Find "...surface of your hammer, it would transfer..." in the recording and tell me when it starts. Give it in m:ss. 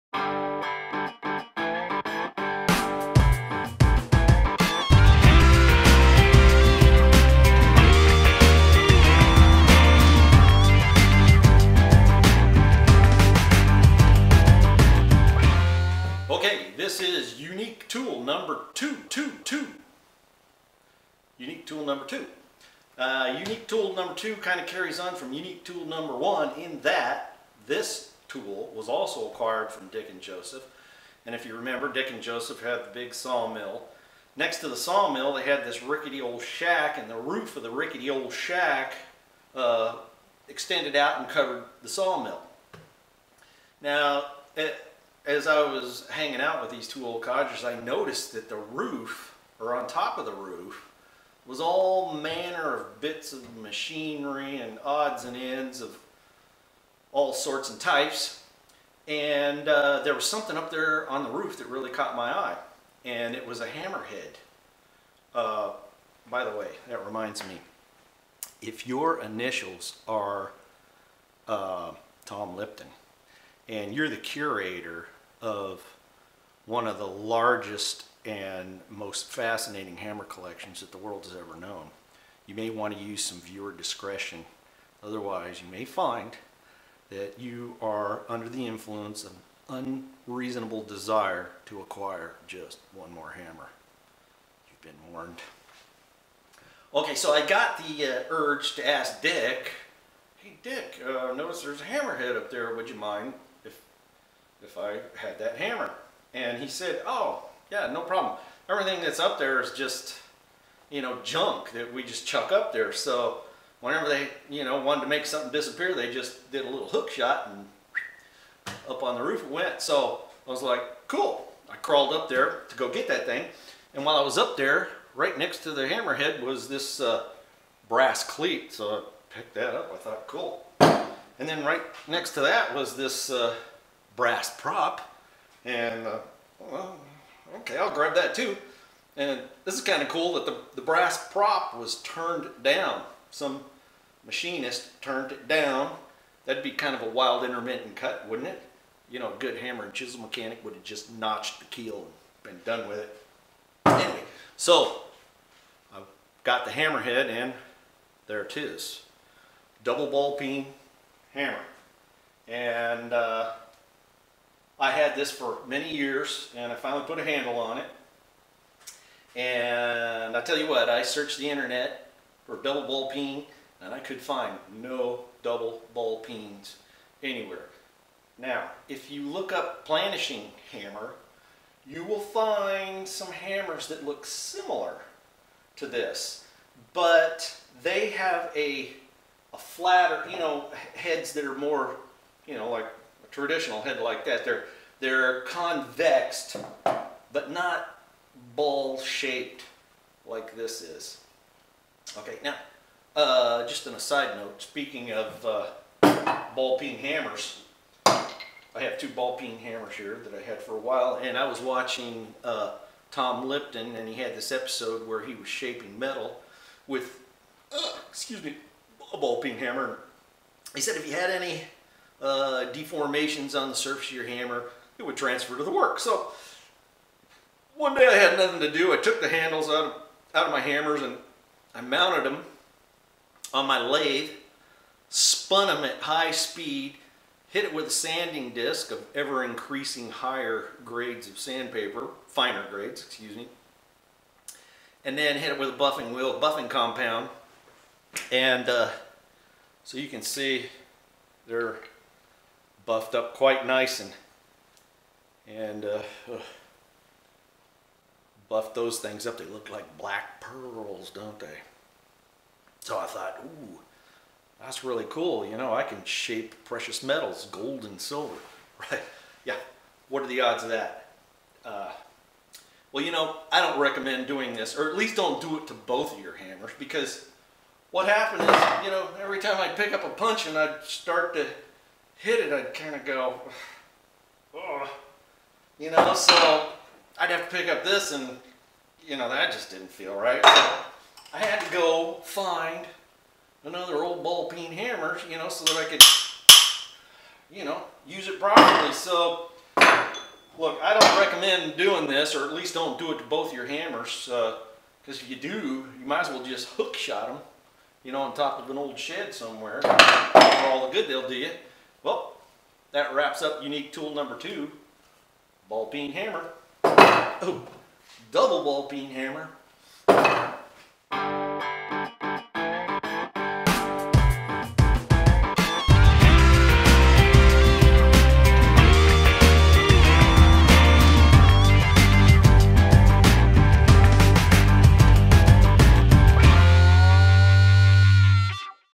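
3:43.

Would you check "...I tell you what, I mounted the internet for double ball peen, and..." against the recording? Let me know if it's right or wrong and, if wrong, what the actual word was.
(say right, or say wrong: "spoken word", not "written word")
wrong: "searched", not "mounted".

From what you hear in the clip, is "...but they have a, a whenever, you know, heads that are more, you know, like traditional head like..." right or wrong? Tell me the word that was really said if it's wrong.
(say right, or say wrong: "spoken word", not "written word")
wrong: "flatter", not "whenever".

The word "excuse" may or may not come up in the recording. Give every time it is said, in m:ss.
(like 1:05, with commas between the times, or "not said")
3:38, 4:03.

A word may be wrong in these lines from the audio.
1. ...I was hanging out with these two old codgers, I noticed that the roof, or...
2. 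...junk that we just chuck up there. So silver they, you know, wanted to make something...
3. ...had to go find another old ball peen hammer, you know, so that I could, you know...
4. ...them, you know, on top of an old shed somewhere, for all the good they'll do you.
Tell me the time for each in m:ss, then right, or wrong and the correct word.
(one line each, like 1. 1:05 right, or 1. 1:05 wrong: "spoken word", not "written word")
1. 0:45 right
2. 1:51 wrong: "whenever", not "silver"
3. 4:51 right
4. 5:07 right.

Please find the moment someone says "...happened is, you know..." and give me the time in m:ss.
4:38.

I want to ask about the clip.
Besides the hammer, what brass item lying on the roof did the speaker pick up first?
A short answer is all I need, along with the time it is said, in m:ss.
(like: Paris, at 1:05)
Brass cleat, at 2:07.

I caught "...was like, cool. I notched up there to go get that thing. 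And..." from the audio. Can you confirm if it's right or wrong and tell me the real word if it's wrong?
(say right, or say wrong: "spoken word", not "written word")
wrong: "crawled", not "notched".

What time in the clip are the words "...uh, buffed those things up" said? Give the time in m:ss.
4:15.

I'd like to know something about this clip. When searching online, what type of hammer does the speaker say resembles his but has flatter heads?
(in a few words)
Planishing hammer.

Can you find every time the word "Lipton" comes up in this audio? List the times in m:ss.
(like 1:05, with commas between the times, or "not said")
1:12, 3:33.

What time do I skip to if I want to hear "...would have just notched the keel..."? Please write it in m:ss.
2:30.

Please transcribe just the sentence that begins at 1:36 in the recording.
Okay, so I got the uh, urge to ask Dick, hey Dick, uh, notice there's a hammerhead up there, would you mind?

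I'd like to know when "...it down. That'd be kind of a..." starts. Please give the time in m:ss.
2:25.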